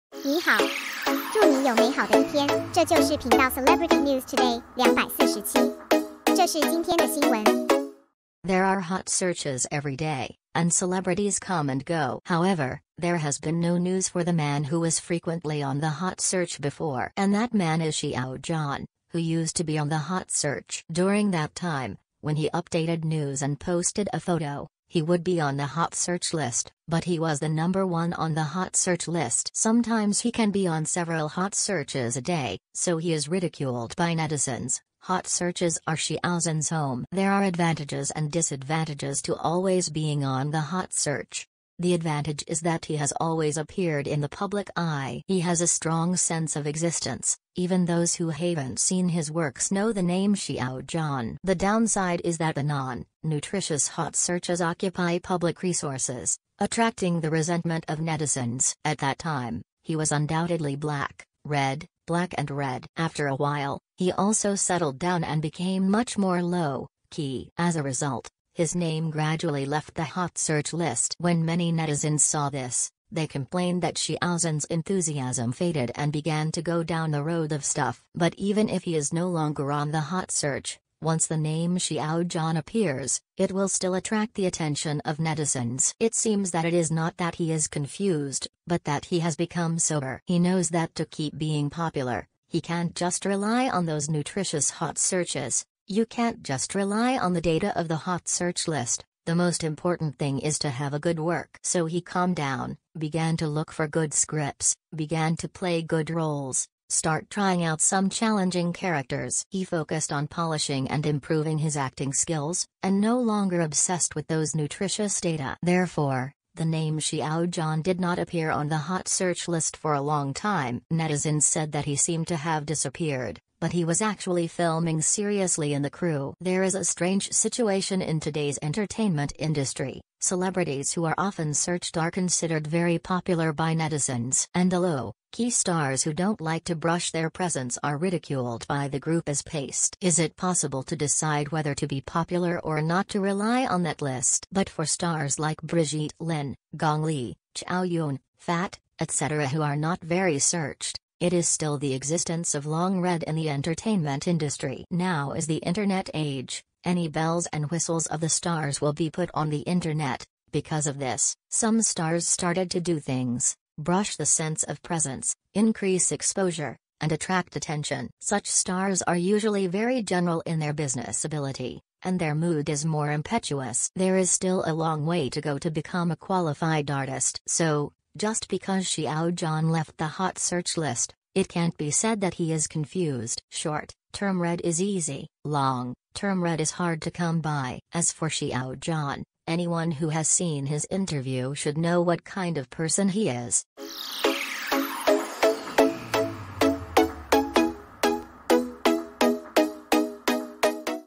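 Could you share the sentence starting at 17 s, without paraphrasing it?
And that man is Xiao John, who used to be on the hot search.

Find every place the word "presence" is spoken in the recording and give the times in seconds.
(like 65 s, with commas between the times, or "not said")
137 s, 164 s.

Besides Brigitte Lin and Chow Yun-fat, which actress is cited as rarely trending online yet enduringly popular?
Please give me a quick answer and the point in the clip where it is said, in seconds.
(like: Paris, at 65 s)
Gong Li, at 146 s.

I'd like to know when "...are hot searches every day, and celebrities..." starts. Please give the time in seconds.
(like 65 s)
8 s.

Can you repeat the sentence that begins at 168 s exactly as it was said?
Such stars are usually very general in their business ability, and their mood is more impetuous.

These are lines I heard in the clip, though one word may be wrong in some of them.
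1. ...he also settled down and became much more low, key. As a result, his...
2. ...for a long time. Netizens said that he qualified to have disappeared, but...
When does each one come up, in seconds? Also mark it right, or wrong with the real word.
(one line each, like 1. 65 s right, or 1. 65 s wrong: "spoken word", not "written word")
1. 63 s right
2. 119 s wrong: "seemed", not "qualified".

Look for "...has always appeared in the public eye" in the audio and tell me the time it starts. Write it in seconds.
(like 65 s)
42 s.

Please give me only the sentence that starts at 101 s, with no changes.
So he calmed down, began to look for good scripts, began to play good roles, start trying out some challenging characters.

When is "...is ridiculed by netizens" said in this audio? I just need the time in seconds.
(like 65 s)
33 s.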